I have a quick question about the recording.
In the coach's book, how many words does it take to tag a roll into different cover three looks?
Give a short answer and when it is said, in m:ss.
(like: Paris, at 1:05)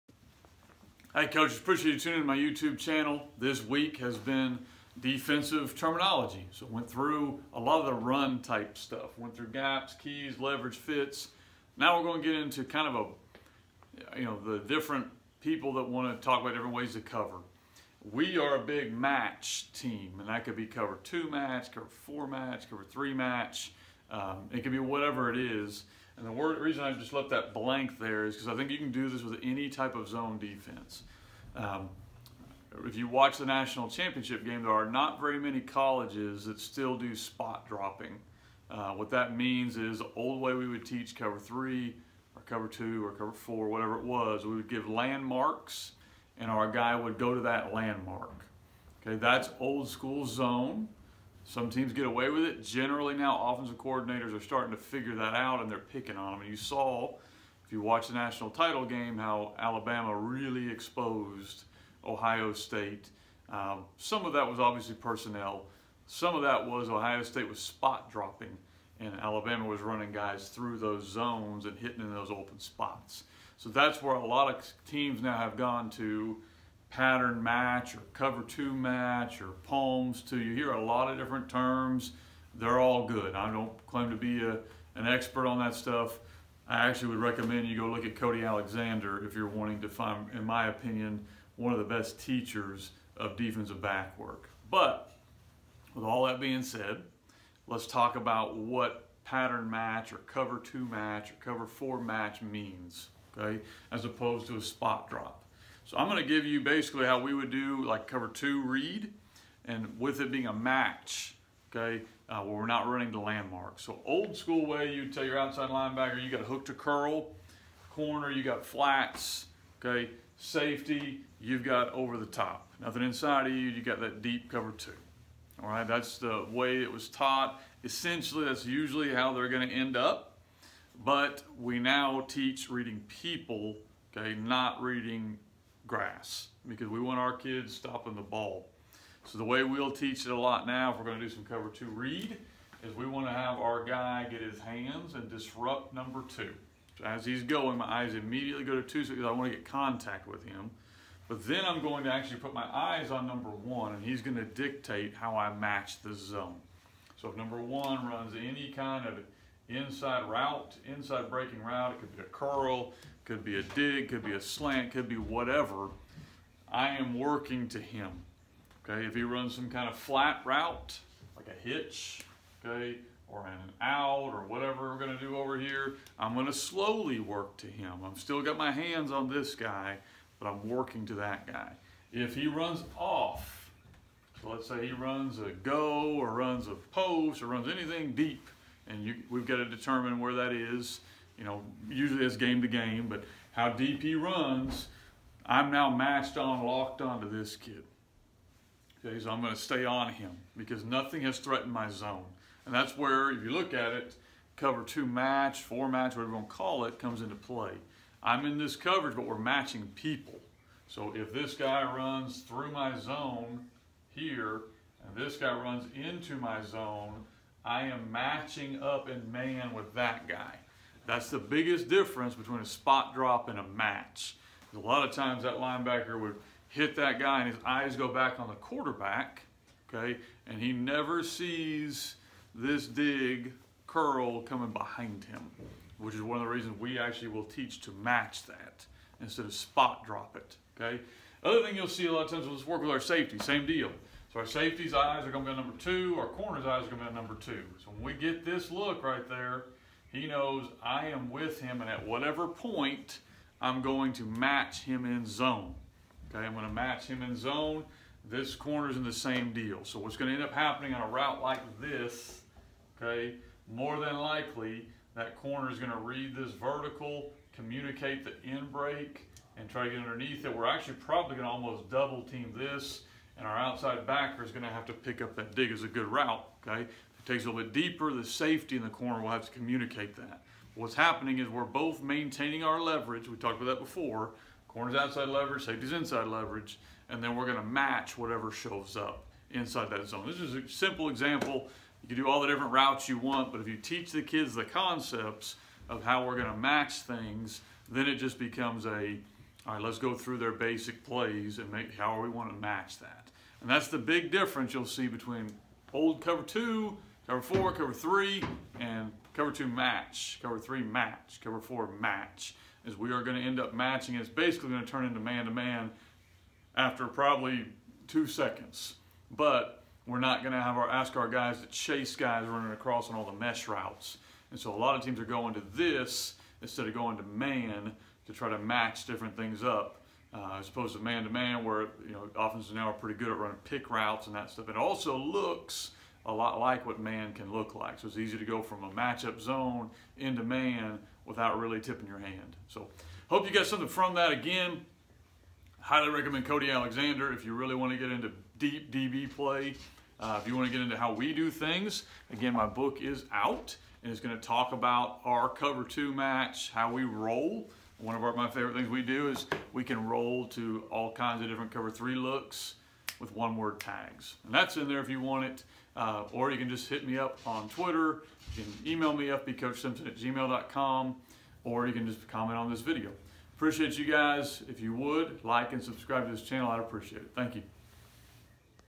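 1, at 6:03.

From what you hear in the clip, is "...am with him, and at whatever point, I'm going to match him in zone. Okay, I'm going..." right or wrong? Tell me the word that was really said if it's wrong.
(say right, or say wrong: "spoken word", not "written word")
right.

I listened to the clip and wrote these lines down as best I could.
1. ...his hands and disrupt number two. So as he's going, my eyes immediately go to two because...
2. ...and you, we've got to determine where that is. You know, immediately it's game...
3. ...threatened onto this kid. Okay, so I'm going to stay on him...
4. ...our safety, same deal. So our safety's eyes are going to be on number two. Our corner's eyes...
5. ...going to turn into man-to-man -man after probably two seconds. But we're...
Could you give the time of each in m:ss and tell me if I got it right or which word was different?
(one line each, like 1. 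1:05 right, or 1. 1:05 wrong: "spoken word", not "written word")
1. 2:24 right
2. 3:08 wrong: "usually", not "immediately"
3. 3:16 wrong: "locked", not "threatened"
4. 4:02 right
5. 5:14 right.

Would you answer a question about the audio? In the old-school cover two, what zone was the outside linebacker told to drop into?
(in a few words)
hook to curl.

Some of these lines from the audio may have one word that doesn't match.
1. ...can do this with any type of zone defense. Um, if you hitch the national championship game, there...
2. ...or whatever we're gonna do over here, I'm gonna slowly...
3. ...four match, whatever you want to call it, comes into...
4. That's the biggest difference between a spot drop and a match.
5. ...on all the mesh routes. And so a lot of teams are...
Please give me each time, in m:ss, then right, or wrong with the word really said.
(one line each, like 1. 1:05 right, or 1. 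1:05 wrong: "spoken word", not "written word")
1. 0:28 wrong: "watch", not "hitch"
2. 2:54 right
3. 3:25 right
4. 3:41 right
5. 5:23 right.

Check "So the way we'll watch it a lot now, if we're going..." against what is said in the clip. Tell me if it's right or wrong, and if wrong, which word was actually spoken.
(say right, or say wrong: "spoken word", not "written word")
wrong: "teach", not "watch".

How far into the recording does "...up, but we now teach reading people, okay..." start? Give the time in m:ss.
2:09.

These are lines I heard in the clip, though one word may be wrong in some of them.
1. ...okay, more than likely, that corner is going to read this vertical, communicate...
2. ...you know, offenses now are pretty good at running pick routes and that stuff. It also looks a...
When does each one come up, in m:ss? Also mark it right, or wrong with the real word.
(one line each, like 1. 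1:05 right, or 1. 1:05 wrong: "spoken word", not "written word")
1. 4:23 right
2. 5:32 right.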